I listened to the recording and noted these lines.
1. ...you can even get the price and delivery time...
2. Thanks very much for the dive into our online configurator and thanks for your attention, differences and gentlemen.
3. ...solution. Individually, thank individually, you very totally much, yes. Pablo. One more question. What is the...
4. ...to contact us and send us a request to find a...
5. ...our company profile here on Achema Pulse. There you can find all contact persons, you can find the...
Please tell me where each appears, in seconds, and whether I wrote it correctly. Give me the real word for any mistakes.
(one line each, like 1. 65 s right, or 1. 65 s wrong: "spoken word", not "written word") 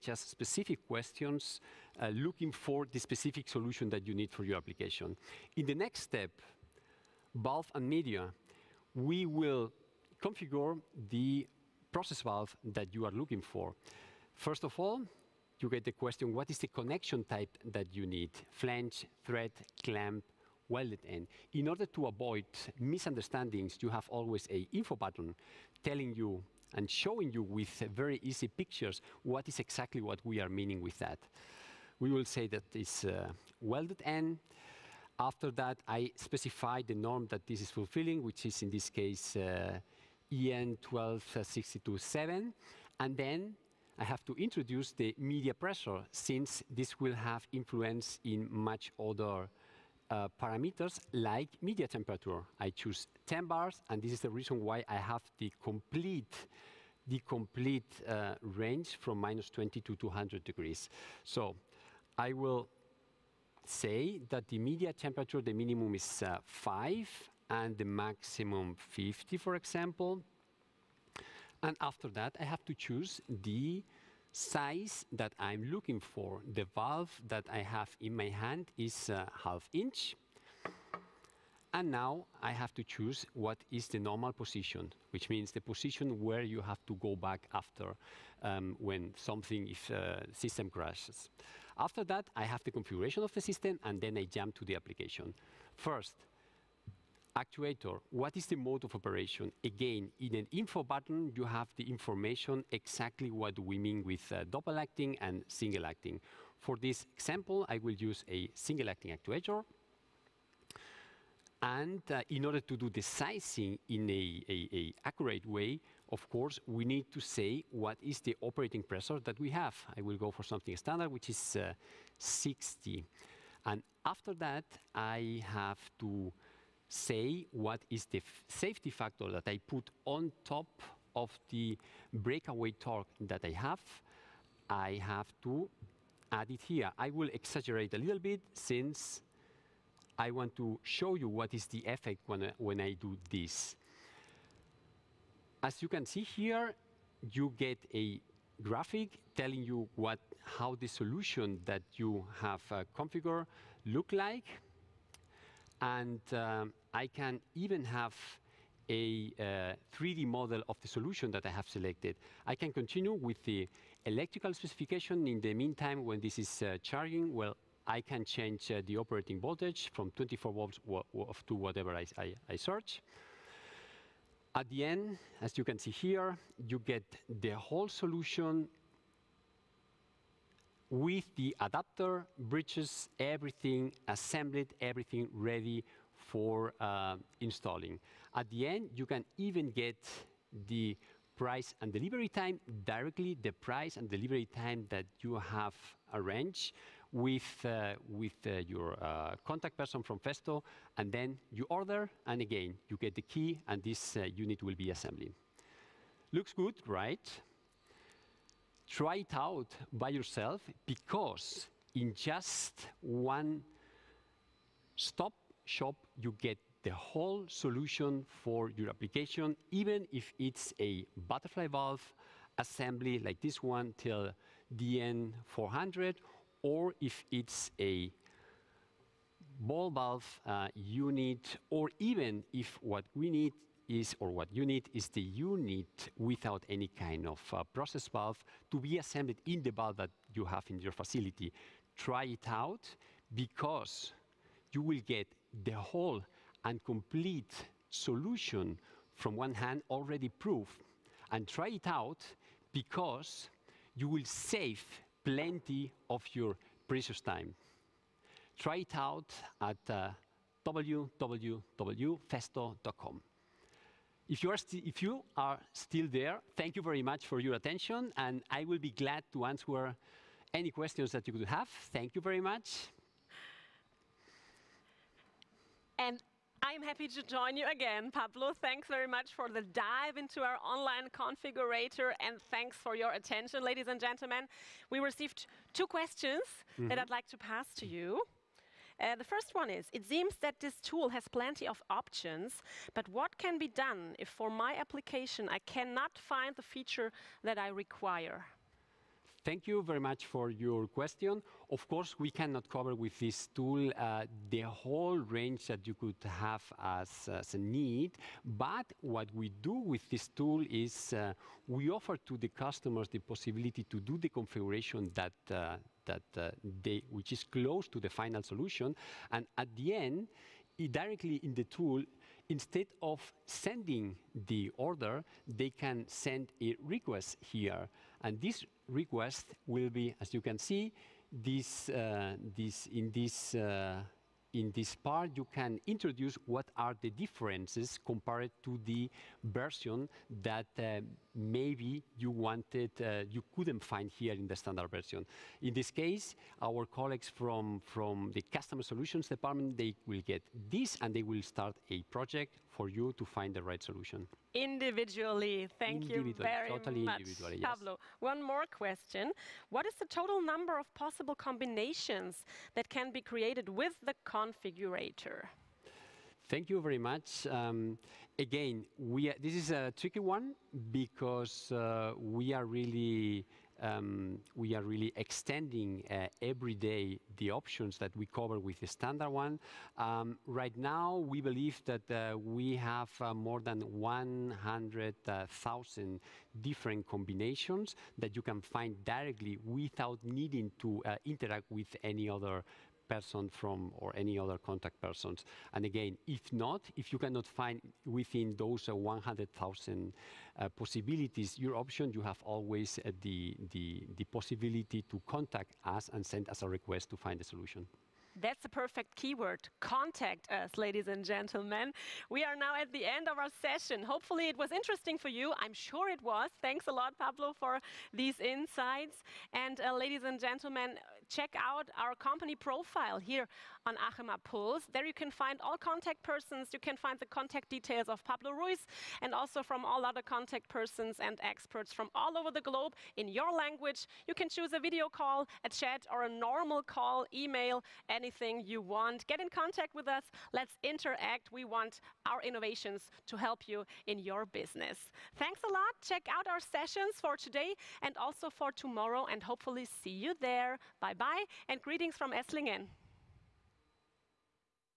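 1. 188 s right
2. 278 s wrong: "ladies", not "differences"
3. 353 s right
4. 405 s right
5. 421 s right.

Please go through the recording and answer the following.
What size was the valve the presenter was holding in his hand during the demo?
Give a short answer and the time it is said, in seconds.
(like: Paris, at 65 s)
half inch, at 79 s.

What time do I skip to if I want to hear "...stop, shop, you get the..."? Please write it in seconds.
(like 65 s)
214 s.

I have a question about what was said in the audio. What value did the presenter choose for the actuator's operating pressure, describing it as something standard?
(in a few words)
60.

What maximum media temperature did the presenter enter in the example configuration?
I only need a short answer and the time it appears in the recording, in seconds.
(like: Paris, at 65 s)
50, at 67 s.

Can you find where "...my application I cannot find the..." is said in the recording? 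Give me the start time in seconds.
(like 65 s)
294 s.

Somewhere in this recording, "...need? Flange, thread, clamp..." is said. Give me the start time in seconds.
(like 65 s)
18 s.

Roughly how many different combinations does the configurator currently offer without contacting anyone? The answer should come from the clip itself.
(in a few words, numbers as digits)
more than 100,000.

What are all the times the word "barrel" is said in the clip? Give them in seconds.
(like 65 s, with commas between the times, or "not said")
not said.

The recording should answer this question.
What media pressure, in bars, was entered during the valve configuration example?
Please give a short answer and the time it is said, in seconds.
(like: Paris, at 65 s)
10 bars, at 53 s.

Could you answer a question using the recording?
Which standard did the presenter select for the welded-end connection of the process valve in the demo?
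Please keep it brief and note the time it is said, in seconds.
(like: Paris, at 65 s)
EN 12627, at 40 s.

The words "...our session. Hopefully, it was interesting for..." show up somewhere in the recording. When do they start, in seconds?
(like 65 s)
413 s.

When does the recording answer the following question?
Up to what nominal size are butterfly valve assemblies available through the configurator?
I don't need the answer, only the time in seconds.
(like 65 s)
224 s.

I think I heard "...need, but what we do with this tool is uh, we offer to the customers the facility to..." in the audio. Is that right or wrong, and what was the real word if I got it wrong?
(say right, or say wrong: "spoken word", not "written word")
wrong: "possibility", not "facility".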